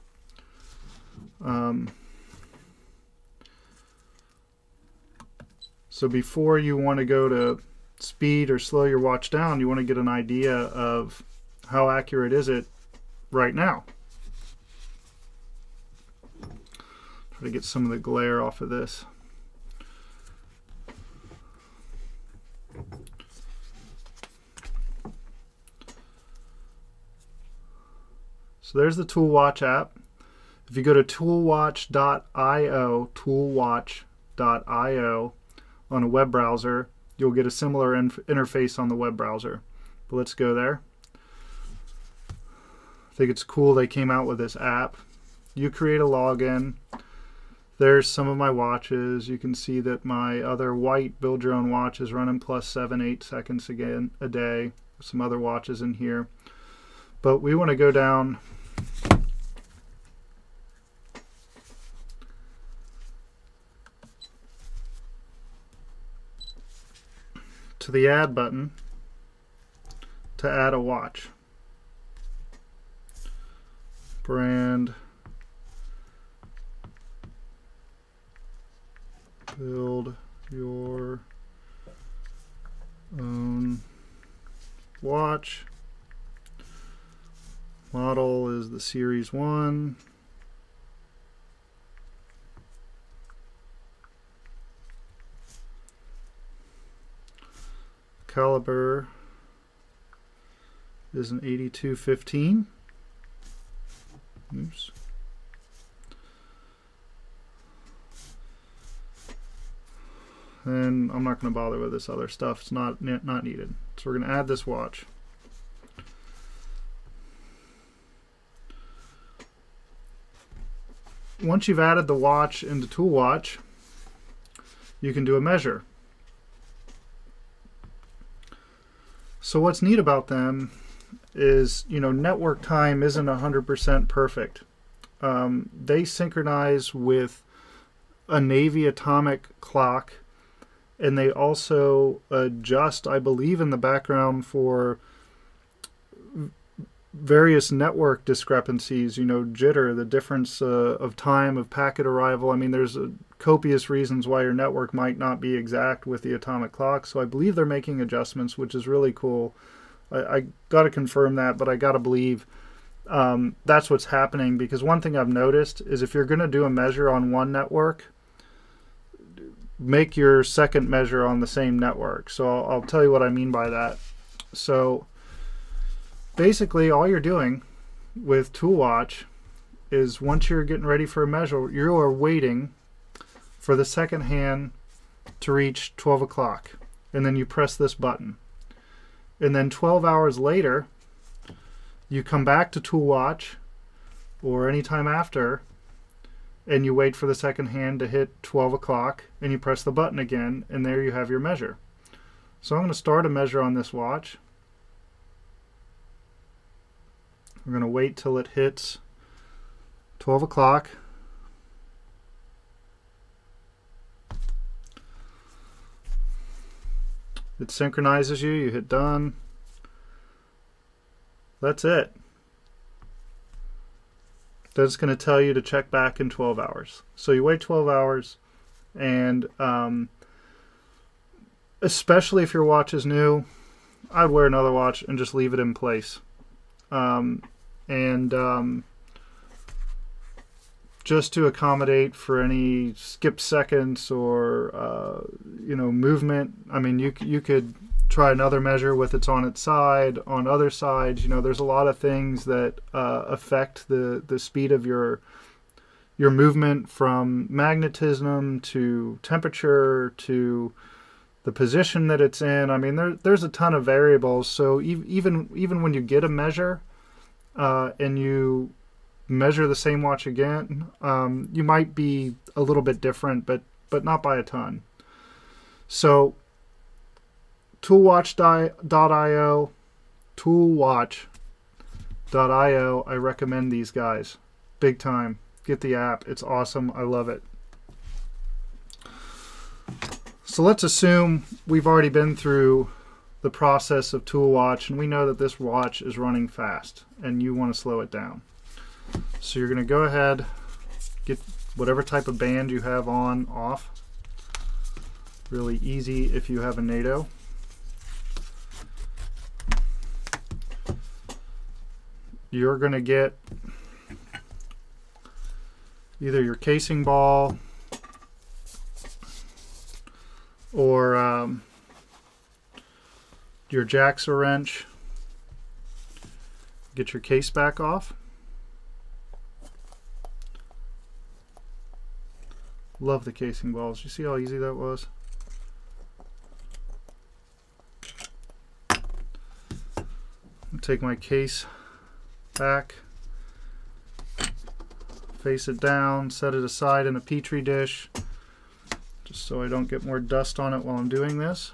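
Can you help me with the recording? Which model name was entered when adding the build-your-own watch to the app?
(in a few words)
Series one.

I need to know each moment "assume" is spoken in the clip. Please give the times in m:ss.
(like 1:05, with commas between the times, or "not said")
4:50.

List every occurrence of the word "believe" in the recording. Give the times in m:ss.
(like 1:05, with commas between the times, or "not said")
2:23, 2:37, 2:41.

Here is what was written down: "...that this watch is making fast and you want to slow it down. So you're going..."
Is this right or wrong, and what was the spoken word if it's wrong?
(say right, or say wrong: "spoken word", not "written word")
wrong: "running", not "making".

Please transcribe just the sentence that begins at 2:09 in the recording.
So what's neat about them is, you know, network time isn't 100% perfect.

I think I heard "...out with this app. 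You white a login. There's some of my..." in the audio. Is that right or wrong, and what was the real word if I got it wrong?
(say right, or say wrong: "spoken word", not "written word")
wrong: "create", not "white".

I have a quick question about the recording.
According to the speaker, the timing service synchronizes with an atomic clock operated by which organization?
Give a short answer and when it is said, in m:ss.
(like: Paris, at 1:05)
Navy, at 2:18.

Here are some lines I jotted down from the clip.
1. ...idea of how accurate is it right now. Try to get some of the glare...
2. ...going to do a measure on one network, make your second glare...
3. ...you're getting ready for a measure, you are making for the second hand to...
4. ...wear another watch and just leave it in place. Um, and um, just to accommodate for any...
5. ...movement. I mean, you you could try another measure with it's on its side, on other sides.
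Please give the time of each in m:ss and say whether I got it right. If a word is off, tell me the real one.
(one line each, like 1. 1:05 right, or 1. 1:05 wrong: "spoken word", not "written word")
1. 0:10 right
2. 2:46 wrong: "measure", not "glare"
3. 3:00 wrong: "waiting", not "making"
4. 3:54 right
5. 4:05 right.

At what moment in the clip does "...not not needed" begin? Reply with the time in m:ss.
1:52.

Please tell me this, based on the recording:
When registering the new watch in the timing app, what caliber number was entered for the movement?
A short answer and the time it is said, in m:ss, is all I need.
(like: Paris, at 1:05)
8215, at 1:41.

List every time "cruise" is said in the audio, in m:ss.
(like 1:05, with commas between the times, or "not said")
not said.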